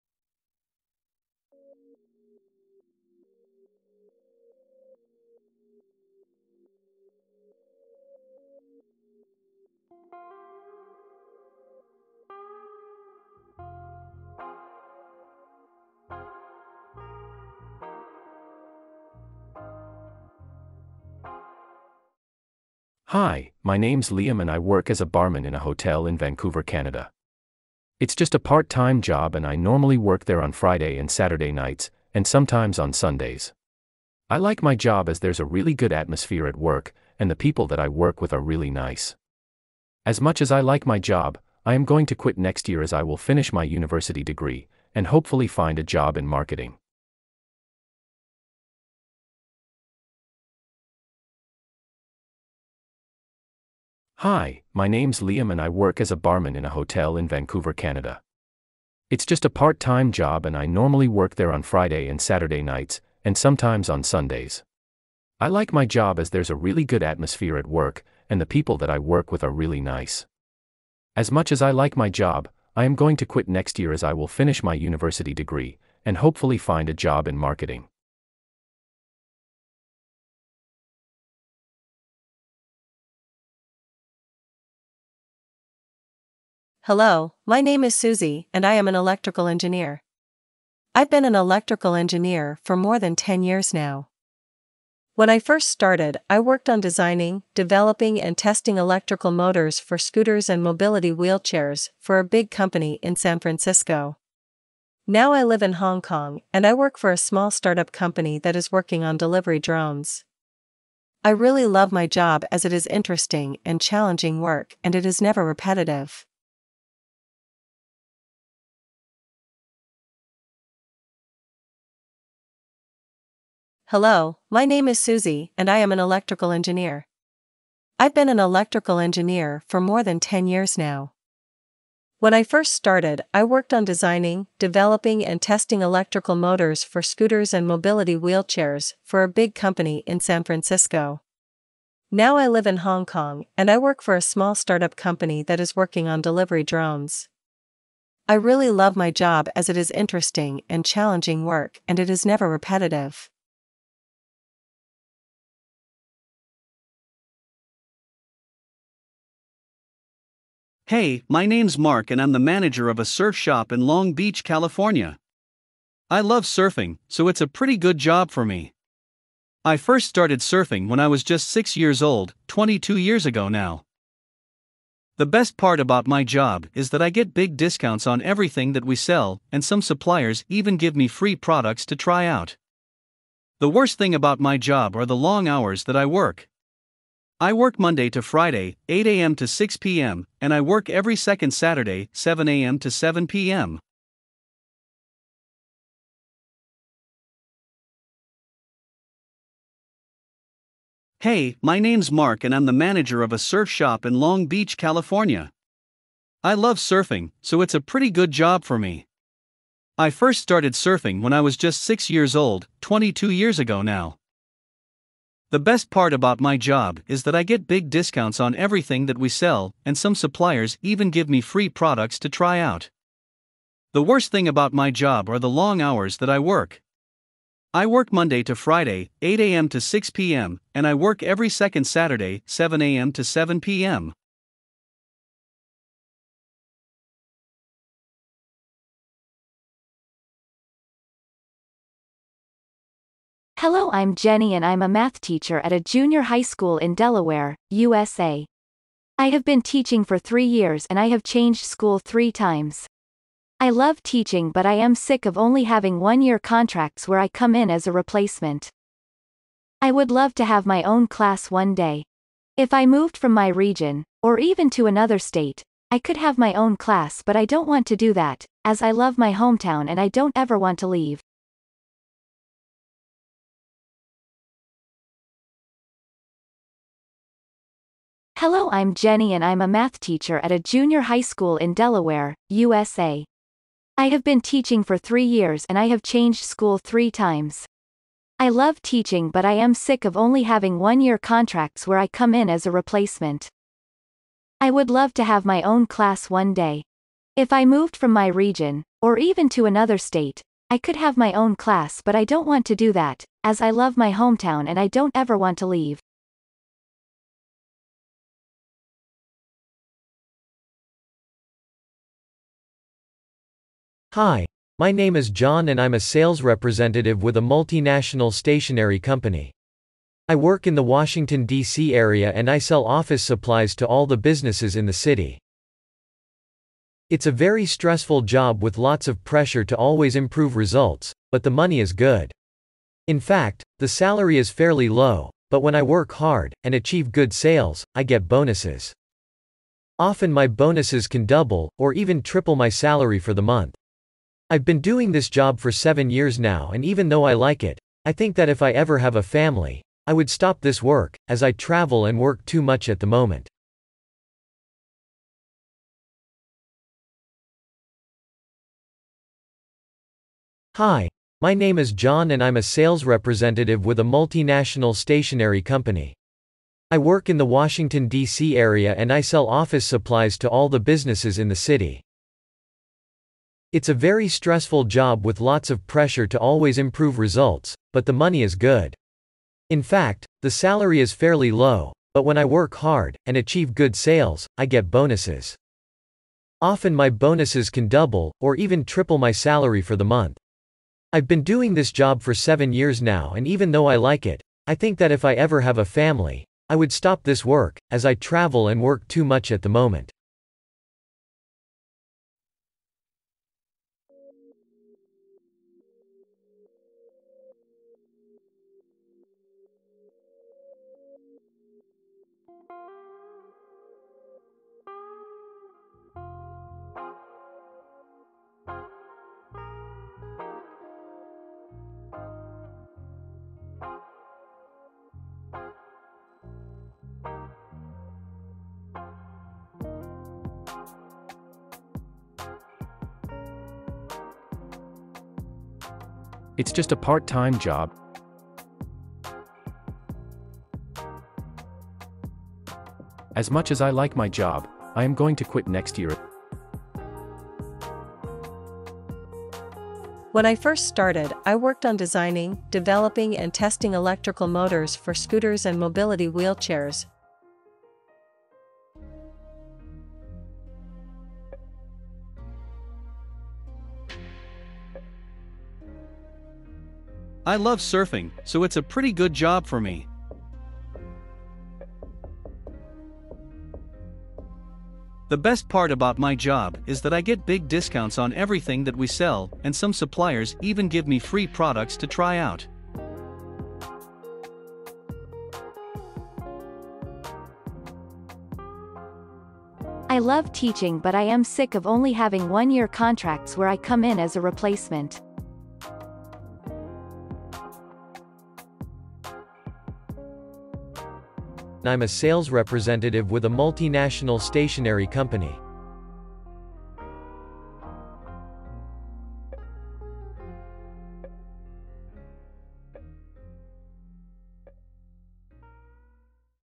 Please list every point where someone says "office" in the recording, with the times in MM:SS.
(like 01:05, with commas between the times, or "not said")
05:22, 06:09.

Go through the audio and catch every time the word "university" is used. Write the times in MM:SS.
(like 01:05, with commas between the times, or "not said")
00:43, 01:14.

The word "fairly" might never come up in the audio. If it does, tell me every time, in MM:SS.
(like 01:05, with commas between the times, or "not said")
05:34, 06:21.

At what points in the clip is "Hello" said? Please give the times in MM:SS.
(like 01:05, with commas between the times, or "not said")
01:26, 02:03, 04:03, 04:38.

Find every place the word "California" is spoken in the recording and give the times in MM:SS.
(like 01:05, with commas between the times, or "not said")
02:44, 03:24.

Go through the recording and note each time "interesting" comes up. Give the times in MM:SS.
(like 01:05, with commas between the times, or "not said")
01:52, 02:29.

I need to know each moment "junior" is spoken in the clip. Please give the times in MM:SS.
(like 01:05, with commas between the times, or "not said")
04:05, 04:40.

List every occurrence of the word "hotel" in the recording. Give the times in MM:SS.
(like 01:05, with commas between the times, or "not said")
00:25, 00:56.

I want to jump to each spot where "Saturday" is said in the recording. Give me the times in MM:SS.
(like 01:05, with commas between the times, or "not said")
00:31, 01:02, 03:11, 03:51.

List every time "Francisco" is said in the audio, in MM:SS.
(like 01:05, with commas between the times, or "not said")
01:43, 02:20.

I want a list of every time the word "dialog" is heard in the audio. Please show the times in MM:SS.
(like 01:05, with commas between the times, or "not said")
not said.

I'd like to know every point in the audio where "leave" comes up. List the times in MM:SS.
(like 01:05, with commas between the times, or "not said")
04:30, 05:05.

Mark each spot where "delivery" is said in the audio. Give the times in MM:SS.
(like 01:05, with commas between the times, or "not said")
01:49, 02:26.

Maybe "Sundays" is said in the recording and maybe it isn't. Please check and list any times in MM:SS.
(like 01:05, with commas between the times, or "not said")
00:32, 01:04.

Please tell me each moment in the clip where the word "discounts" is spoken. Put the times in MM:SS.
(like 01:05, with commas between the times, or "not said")
02:57, 03:37, 07:57.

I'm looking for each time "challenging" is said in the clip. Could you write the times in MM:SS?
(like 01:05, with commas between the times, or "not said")
01:53, 02:30.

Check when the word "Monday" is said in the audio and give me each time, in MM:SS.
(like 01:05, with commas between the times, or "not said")
03:07, 03:48.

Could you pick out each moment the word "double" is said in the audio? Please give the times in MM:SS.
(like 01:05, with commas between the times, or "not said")
05:41, 06:27.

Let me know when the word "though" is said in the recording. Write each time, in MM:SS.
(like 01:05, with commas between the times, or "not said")
05:47, 06:33.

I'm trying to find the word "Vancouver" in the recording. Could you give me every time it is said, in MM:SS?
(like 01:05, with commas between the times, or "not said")
00:26, 00:57.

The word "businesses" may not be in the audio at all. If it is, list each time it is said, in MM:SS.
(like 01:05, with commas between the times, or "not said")
05:24, 06:10.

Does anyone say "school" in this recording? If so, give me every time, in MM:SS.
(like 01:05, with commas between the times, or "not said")
04:06, 04:11, 04:41, 04:46.